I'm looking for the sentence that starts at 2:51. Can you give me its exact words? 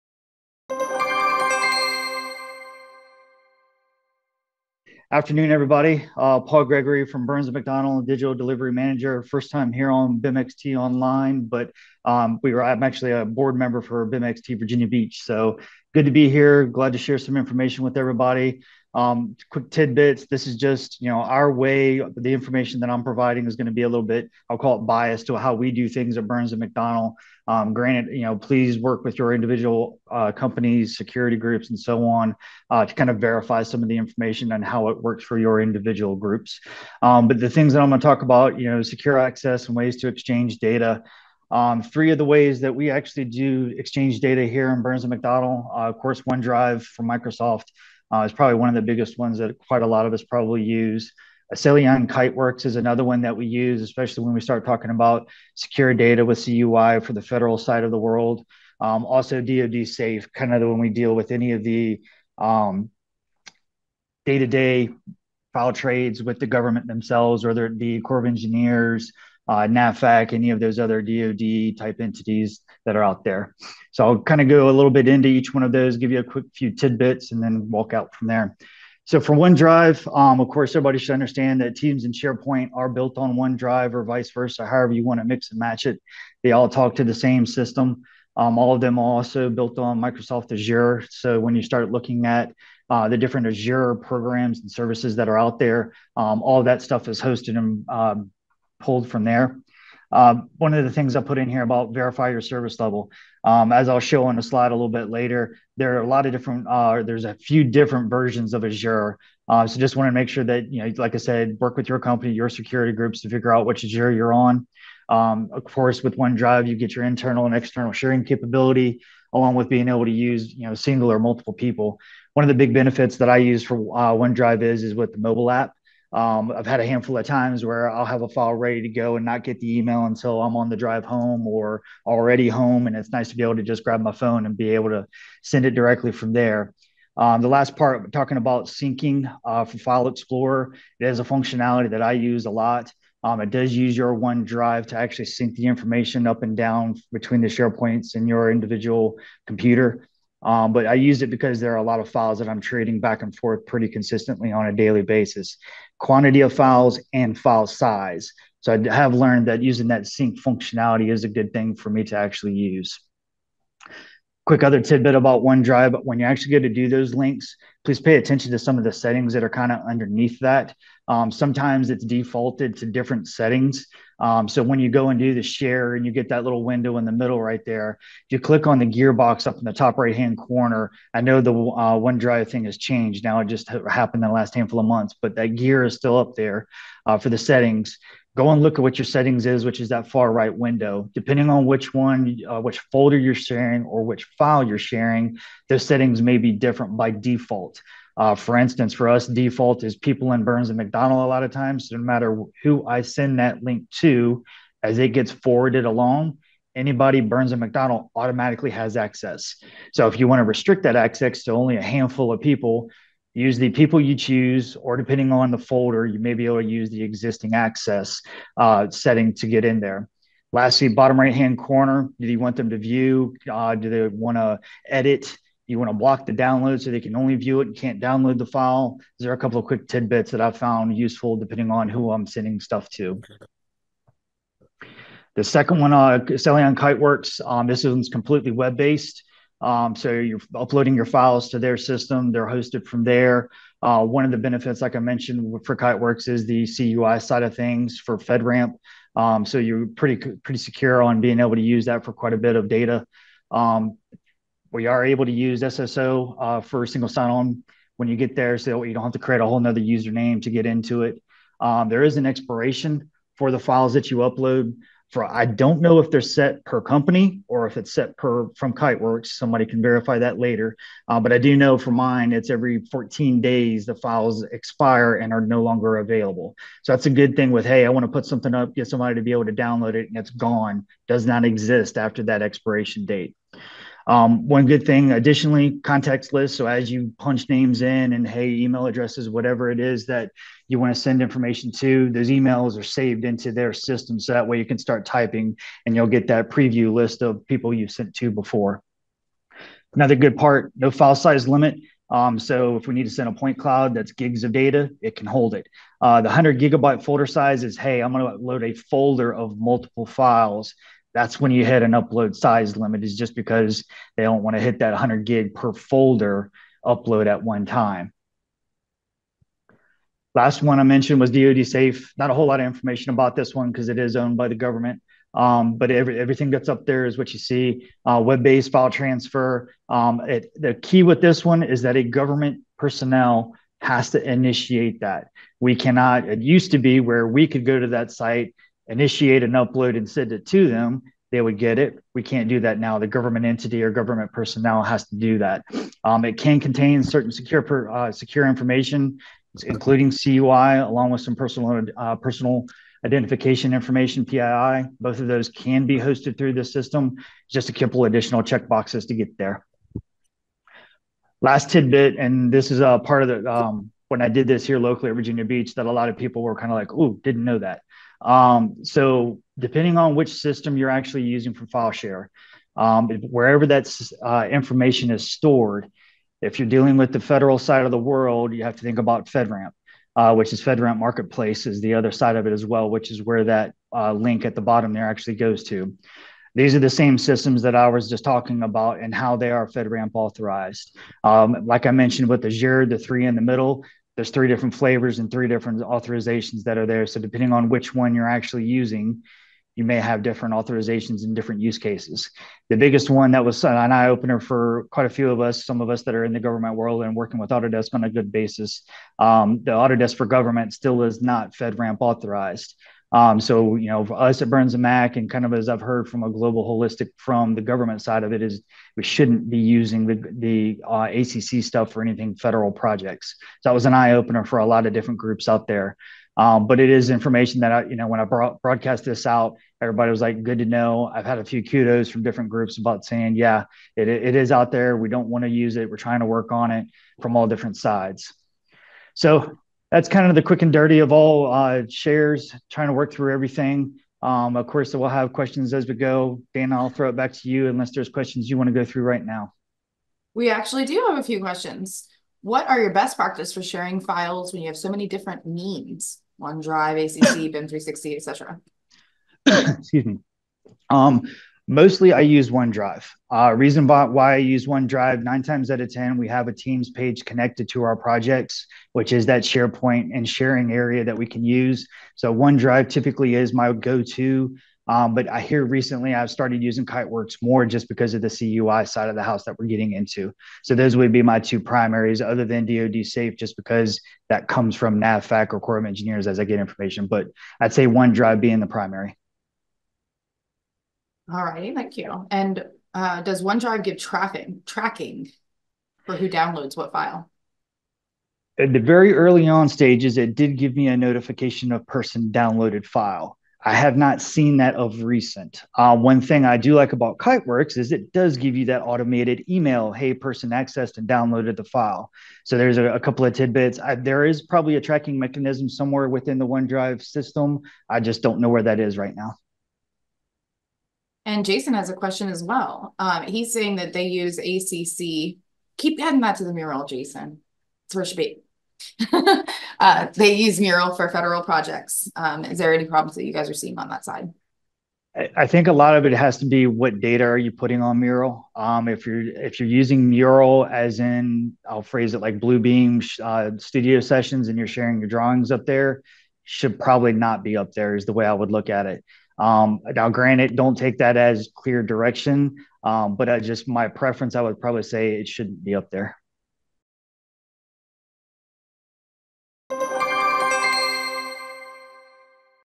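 Um, sometimes it's defaulted to different settings.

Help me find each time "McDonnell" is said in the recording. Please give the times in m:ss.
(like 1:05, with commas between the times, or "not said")
0:07, 0:26, 0:45, 3:20, 3:27.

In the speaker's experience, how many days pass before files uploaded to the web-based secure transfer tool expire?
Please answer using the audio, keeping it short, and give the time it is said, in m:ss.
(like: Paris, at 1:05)
14 days, at 4:32.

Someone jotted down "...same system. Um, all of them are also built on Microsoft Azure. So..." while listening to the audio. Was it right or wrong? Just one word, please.
right.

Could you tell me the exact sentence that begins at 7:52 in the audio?
So OneDrive typically is my go to.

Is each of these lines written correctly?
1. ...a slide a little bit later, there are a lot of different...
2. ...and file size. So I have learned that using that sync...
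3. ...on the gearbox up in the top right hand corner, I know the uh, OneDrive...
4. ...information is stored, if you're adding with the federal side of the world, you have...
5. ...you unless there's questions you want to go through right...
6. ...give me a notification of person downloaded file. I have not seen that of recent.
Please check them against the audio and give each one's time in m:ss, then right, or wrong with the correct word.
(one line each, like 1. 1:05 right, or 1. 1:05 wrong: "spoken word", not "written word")
1. 1:44 right
2. 2:37 right
3. 2:58 right
4. 6:14 wrong: "dealing", not "adding"
5. 7:27 right
6. 8:20 right.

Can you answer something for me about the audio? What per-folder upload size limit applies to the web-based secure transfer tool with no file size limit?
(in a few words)
100 gigabytes.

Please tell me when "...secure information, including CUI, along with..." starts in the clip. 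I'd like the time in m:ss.
5:48.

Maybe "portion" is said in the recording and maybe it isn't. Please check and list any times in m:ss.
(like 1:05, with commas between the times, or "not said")
not said.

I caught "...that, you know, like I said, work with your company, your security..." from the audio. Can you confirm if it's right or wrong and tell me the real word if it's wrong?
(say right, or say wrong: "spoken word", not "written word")
right.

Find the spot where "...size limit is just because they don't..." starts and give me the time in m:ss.
5:12.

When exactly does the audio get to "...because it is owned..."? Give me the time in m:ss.
5:23.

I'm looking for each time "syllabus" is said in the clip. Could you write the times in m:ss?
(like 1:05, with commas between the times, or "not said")
not said.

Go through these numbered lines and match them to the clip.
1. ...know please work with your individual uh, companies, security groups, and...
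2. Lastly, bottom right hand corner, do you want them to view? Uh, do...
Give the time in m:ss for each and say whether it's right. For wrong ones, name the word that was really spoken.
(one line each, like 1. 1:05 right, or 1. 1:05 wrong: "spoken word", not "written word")
1. 0:28 right
2. 3:40 right.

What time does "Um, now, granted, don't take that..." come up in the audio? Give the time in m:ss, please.
9:09.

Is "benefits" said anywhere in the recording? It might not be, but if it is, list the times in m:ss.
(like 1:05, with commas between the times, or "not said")
2:02, 4:04.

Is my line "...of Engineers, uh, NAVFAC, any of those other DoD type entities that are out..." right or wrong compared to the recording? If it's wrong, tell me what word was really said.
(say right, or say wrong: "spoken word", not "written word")
right.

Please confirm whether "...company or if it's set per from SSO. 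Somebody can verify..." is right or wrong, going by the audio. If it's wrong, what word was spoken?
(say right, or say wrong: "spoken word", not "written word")
wrong: "Kiteworks", not "SSO".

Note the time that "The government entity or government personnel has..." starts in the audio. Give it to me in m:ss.
5:42.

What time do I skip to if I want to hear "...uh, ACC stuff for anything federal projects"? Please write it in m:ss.
7:00.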